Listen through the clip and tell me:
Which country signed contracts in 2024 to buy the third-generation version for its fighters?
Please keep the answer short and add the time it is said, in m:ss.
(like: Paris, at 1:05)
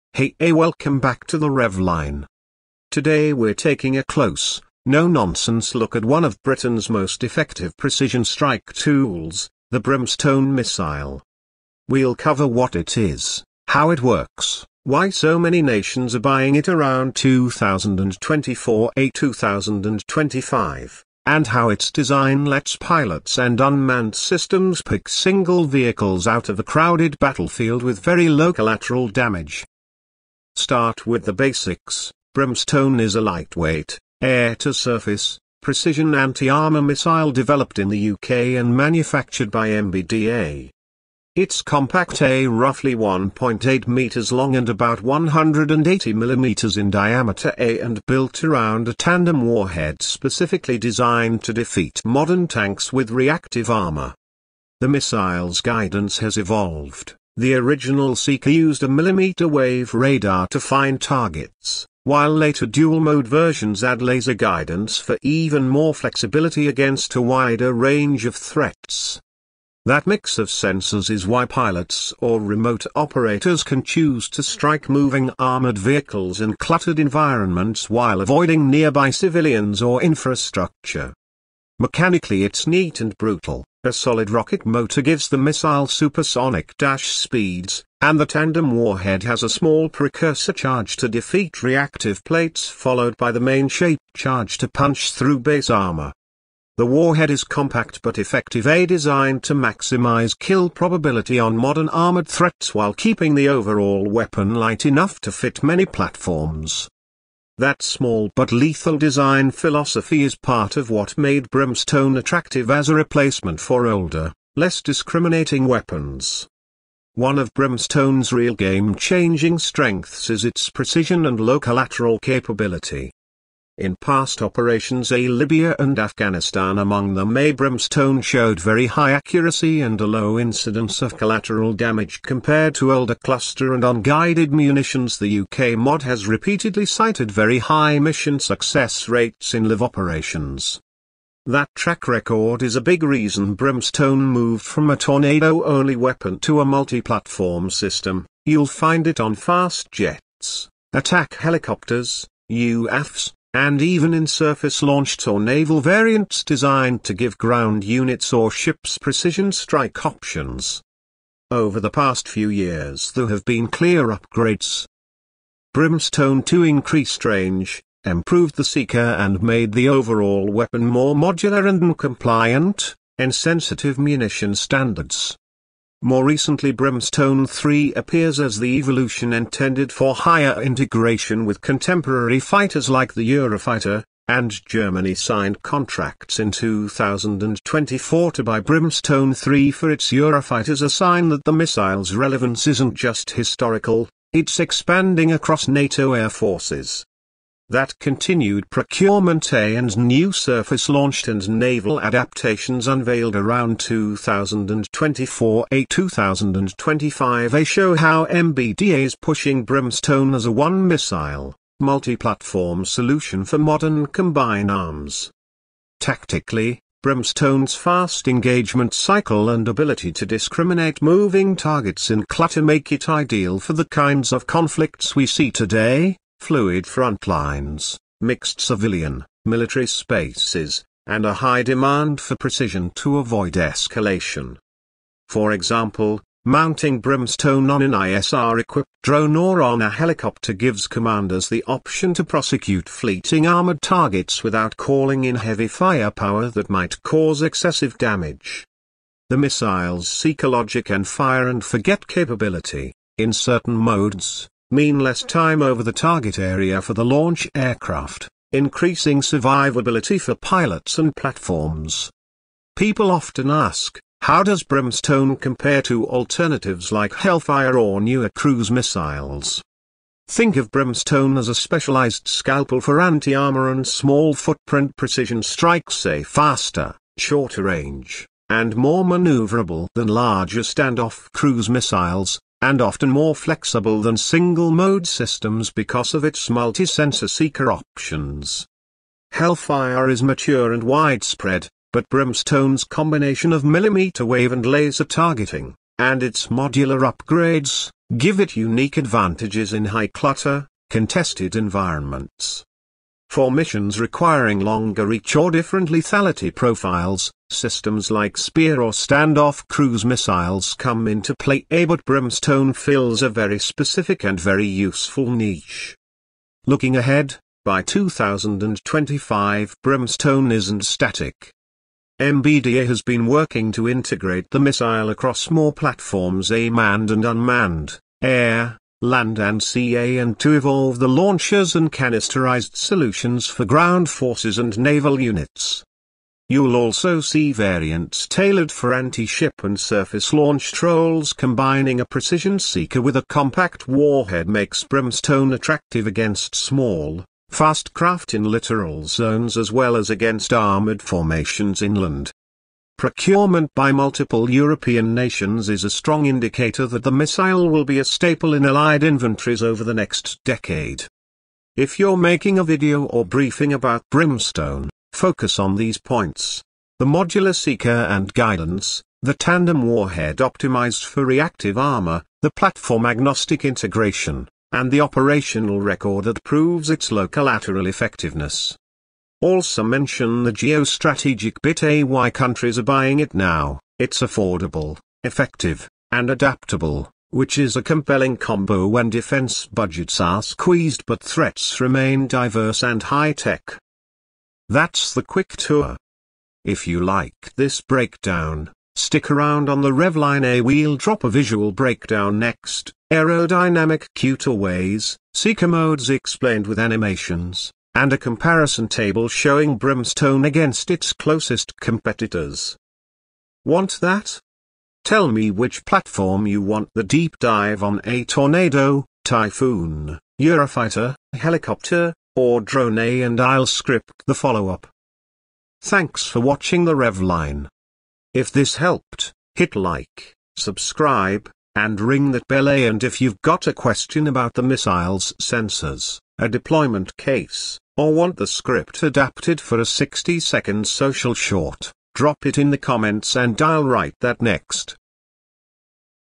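Germany, at 3:04.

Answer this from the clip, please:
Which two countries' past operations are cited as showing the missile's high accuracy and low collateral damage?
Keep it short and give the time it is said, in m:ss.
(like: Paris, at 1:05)
Libya and Afghanistan, at 2:05.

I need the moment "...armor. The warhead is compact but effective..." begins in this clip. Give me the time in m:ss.
1:35.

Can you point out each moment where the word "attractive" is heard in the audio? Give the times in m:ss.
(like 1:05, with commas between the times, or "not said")
1:52, 5:45.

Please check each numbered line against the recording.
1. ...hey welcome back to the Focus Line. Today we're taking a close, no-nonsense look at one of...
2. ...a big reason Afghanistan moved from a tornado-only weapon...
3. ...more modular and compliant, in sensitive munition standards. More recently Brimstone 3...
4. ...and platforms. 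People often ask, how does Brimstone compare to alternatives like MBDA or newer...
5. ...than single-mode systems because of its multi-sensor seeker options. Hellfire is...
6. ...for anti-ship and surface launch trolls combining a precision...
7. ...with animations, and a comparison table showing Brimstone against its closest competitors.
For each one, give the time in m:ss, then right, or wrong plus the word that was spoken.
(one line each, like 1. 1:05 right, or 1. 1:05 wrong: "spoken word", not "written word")
1. 0:00 wrong: "Rev", not "Focus"
2. 2:22 wrong: "Brimstone", not "Afghanistan"
3. 2:50 right
4. 4:20 wrong: "Hellfire", not "MBDA"
5. 4:44 right
6. 5:38 right
7. 6:46 right.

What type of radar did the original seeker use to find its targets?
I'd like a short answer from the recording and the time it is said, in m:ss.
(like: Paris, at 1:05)
Millimeter wave radar, at 0:58.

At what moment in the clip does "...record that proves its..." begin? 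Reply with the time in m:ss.
6:15.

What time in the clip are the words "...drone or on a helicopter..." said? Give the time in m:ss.
3:59.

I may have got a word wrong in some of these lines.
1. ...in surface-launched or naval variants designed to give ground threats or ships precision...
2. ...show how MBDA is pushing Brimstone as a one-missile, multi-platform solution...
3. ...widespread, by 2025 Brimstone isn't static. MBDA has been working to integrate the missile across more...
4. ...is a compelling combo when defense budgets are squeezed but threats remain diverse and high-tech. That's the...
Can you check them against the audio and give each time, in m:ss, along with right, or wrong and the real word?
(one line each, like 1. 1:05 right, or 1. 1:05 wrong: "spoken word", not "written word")
1. 2:34 wrong: "units", not "threats"
2. 3:27 right
3. 5:16 wrong: "ahead", not "widespread"
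4. 6:27 right.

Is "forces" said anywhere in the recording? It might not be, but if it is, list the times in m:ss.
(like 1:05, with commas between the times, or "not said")
3:16, 5:34.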